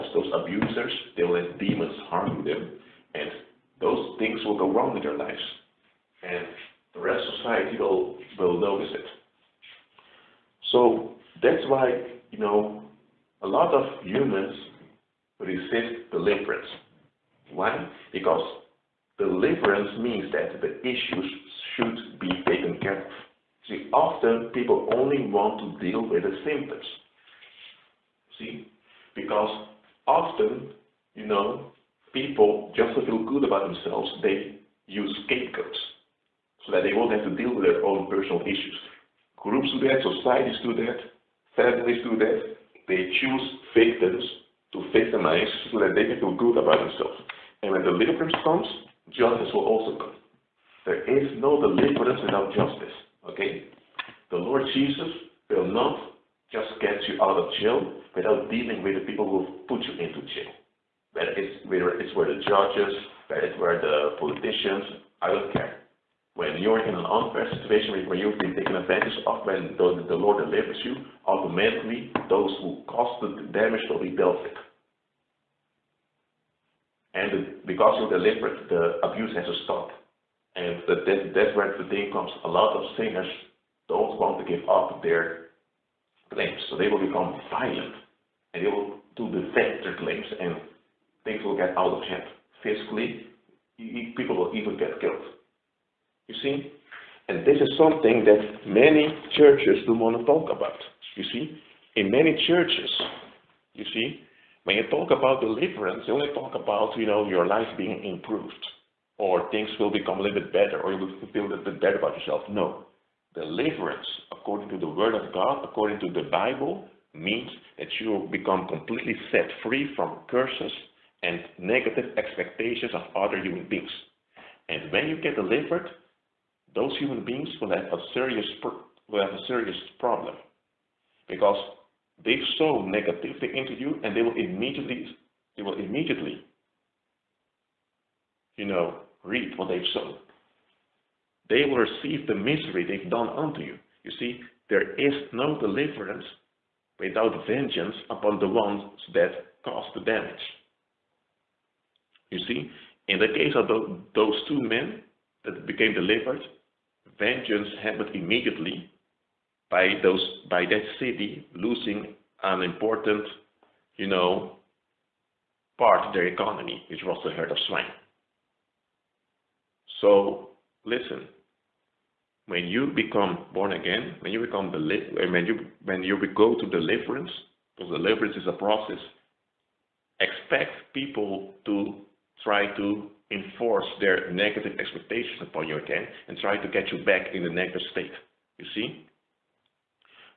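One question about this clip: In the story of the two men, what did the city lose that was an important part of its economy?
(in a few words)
The herd of swine.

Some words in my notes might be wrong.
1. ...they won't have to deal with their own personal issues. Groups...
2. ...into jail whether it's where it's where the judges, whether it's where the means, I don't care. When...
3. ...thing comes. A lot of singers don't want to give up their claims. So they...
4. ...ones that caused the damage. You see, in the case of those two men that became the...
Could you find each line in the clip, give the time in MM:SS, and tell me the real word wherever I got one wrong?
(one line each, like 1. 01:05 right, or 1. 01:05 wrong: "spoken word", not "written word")
1. 00:36 right
2. 00:59 wrong: "politicians", not "means"
3. 01:21 right
4. 02:28 right.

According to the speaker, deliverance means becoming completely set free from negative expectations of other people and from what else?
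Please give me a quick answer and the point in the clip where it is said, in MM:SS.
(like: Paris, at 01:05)
Curses, at 02:00.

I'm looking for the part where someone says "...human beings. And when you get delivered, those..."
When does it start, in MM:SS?
02:03.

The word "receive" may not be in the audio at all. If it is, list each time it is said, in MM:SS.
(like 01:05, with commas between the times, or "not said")
02:21.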